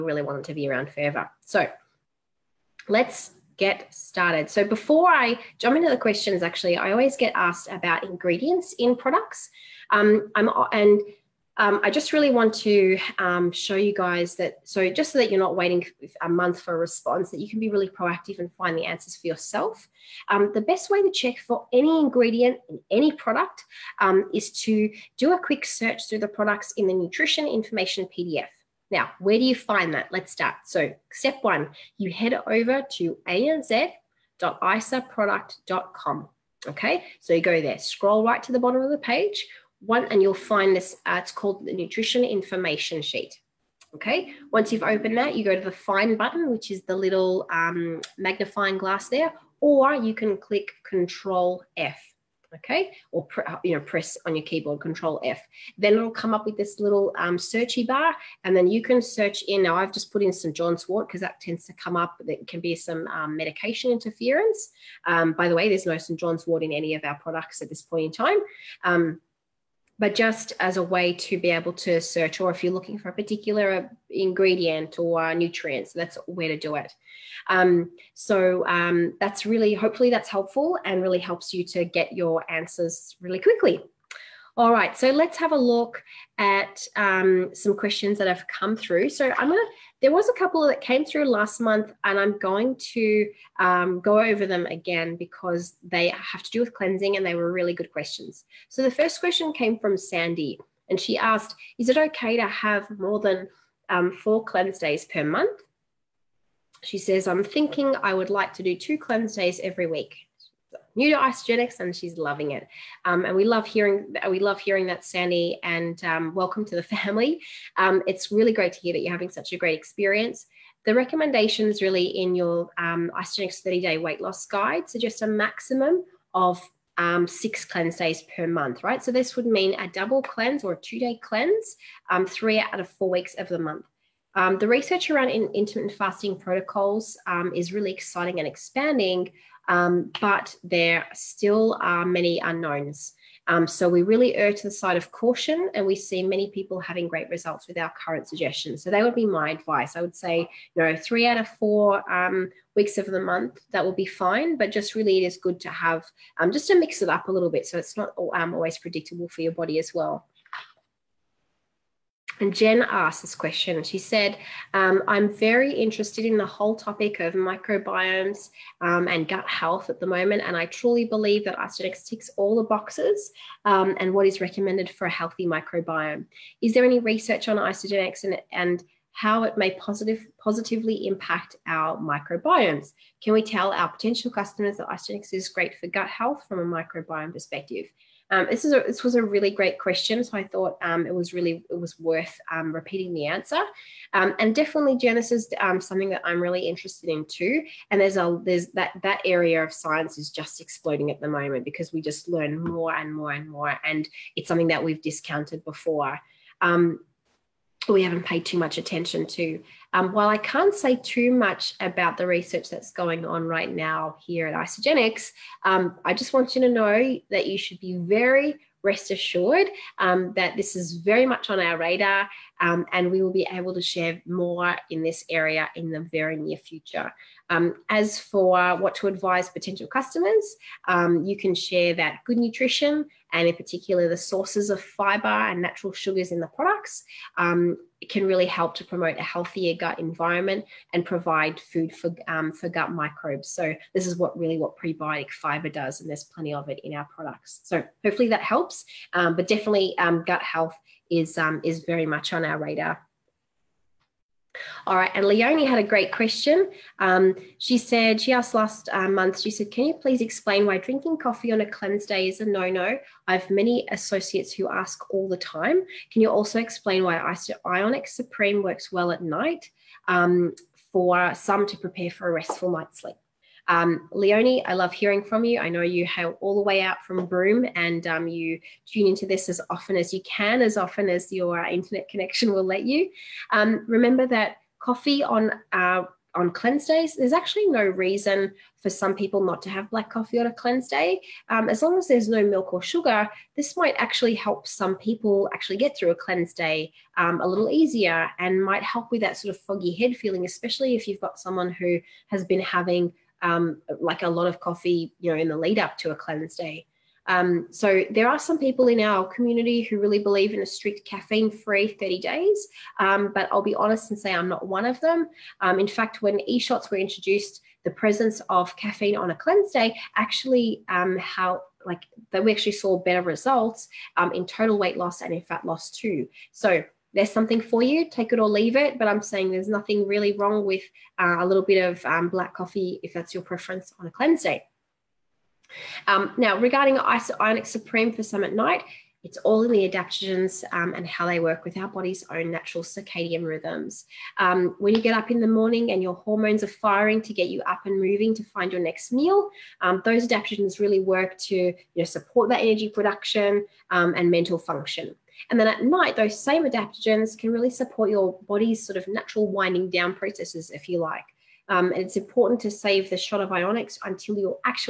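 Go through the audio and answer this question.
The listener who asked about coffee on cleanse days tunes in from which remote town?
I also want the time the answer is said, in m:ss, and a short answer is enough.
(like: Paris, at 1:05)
Broome, at 4:37.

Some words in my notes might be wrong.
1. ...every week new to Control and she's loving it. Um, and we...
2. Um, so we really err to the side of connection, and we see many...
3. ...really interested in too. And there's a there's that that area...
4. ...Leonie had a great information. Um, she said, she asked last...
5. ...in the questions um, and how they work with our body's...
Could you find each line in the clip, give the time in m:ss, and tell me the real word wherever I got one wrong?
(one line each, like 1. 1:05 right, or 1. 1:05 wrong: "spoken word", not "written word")
1. 1:49 wrong: "Isagenix", not "Control"
2. 2:23 wrong: "caution", not "connection"
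3. 3:16 right
4. 4:15 wrong: "question", not "information"
5. 5:39 wrong: "adaptogens", not "questions".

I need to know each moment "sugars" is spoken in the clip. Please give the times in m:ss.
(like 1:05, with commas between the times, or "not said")
3:55, 4:52.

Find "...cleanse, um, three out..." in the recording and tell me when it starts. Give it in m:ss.
2:11.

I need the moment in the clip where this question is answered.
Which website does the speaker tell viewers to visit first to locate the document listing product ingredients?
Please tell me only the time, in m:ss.
0:33.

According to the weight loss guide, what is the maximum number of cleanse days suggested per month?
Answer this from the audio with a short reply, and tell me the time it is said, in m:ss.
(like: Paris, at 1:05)
6, at 2:07.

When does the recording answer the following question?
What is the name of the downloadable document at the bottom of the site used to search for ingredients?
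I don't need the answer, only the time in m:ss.
0:41.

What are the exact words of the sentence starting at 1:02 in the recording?
That can be some um, medication interference.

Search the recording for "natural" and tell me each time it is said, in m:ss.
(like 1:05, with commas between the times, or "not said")
3:55, 5:42, 5:59.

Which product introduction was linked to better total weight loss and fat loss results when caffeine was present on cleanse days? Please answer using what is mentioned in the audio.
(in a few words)
e-shots.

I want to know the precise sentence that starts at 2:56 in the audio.
Is there any research on Isagenix and, and how it may positive, positively impact our microbiomes?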